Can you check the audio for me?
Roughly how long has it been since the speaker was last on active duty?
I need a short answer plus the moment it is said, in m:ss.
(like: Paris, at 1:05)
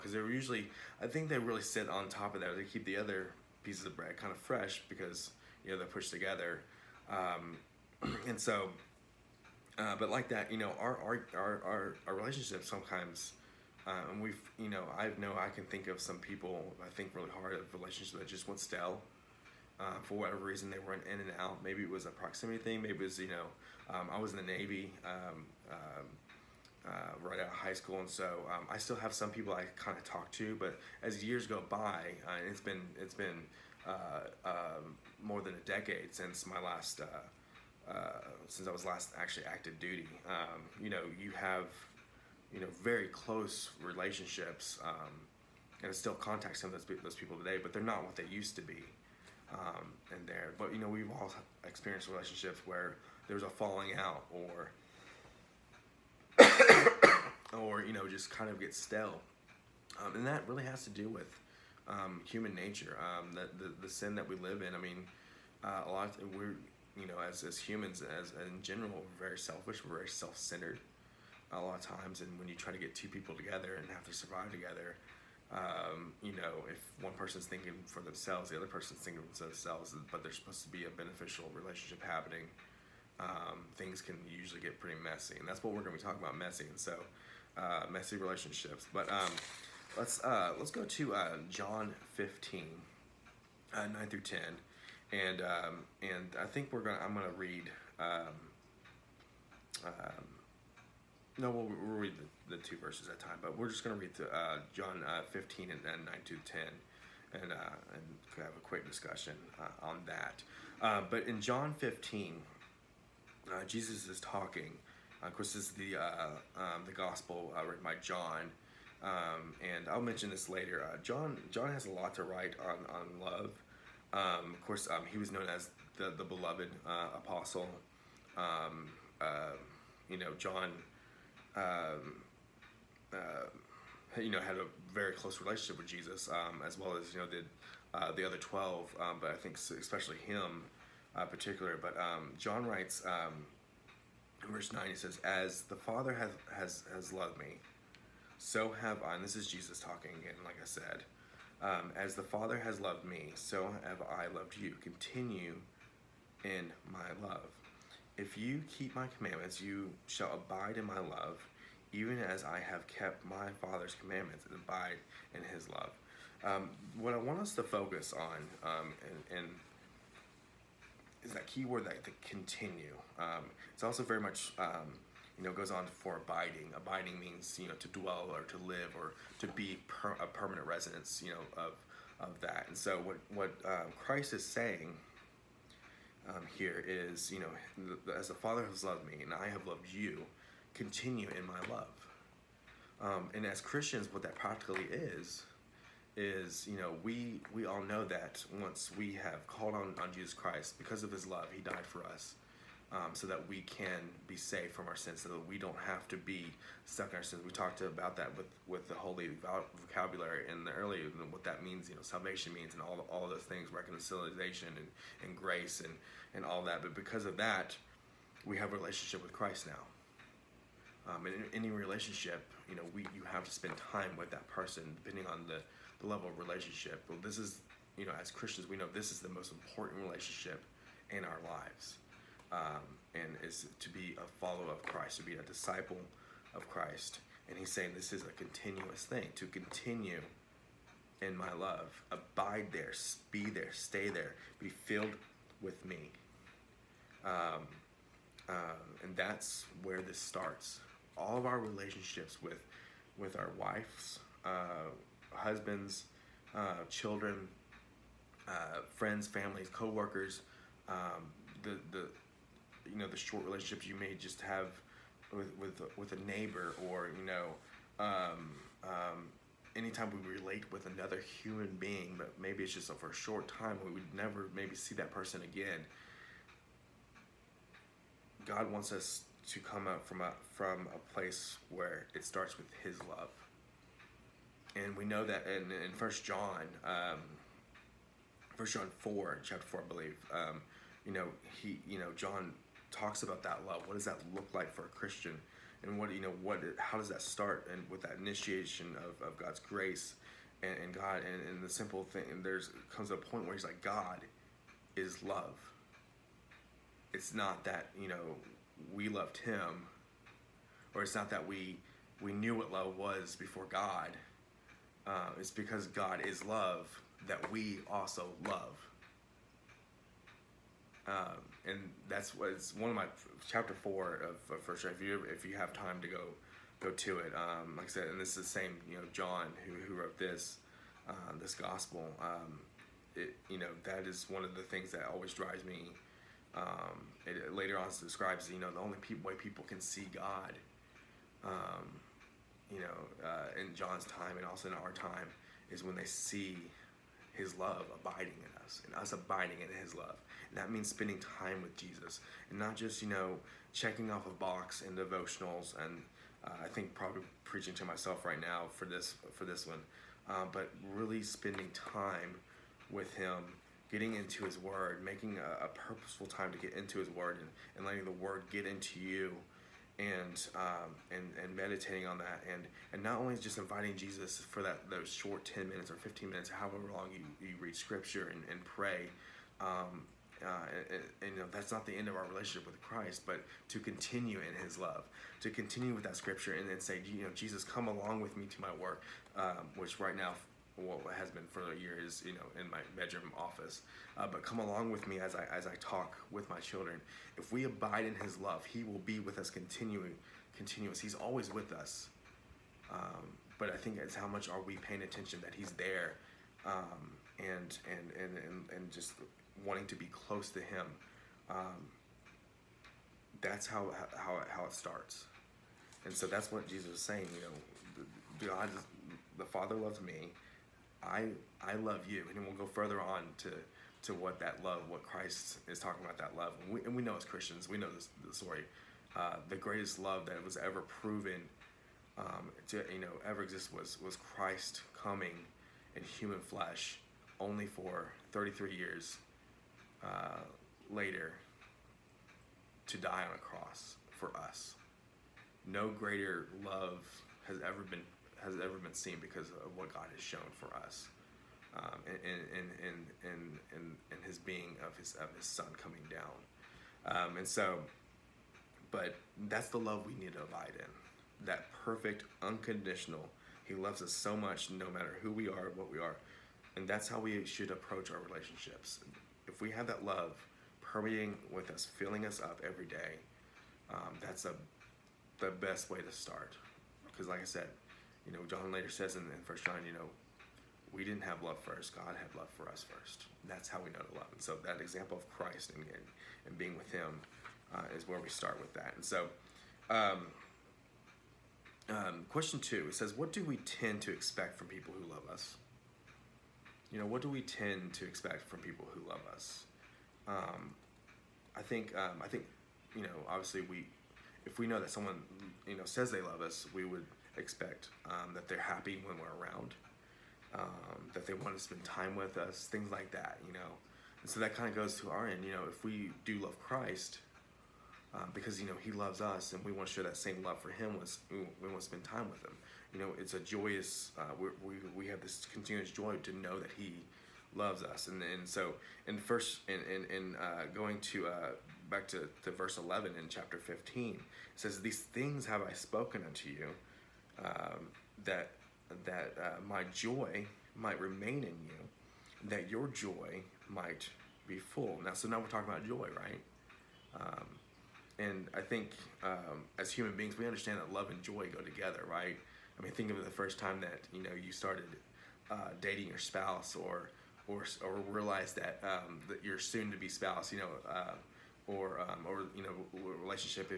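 more than a decade, at 0:35.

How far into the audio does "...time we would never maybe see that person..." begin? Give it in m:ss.
4:33.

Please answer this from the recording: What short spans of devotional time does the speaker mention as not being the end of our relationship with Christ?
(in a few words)
10 or 15 minutes.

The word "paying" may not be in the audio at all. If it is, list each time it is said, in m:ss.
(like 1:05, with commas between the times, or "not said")
6:44.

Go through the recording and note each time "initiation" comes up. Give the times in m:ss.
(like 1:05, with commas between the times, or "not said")
4:58.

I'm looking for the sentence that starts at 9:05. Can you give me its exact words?
Now, so now we're talking about joy, right?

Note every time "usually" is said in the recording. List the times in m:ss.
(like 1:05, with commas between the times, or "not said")
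0:00, 1:24.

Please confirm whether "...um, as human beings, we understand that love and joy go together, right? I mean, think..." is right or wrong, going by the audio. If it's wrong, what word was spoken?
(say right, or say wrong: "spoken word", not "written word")
right.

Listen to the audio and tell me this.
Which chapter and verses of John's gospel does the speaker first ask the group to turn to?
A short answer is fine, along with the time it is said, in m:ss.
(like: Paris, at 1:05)
John 15:9-10, at 1:31.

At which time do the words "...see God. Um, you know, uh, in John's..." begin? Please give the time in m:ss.
5:39.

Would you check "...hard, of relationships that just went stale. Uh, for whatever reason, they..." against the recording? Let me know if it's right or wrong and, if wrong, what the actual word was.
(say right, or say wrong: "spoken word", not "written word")
right.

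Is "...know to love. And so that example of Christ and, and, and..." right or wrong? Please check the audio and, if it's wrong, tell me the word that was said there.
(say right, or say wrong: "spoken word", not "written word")
right.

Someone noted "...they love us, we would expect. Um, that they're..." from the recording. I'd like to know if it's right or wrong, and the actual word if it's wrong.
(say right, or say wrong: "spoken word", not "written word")
right.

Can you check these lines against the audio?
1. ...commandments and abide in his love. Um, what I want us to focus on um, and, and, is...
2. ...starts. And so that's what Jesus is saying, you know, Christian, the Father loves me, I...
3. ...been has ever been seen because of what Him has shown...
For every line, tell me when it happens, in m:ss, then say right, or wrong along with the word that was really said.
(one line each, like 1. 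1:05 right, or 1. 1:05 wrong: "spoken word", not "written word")
1. 2:43 right
2. 6:54 wrong: "God", not "Christian"
3. 7:27 wrong: "God", not "Him".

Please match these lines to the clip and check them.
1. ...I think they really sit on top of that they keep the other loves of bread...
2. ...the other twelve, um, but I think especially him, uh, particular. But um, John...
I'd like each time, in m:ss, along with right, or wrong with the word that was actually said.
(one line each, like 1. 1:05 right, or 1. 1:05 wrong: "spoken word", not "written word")
1. 0:00 wrong: "pieces", not "loves"
2. 2:18 right.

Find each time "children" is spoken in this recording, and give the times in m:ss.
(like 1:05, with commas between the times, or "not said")
4:16, 6:36.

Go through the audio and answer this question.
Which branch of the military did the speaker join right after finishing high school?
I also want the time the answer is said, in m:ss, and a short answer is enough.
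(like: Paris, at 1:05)
Navy, at 0:24.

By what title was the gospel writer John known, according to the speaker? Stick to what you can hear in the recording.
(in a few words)
the beloved apostle.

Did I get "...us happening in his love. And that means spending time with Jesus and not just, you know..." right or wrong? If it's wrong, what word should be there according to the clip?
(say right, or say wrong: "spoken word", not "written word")
wrong: "abiding", not "happening".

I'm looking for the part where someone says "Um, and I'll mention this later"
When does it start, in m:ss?
1:59.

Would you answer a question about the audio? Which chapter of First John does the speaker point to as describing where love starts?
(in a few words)
chapter 4.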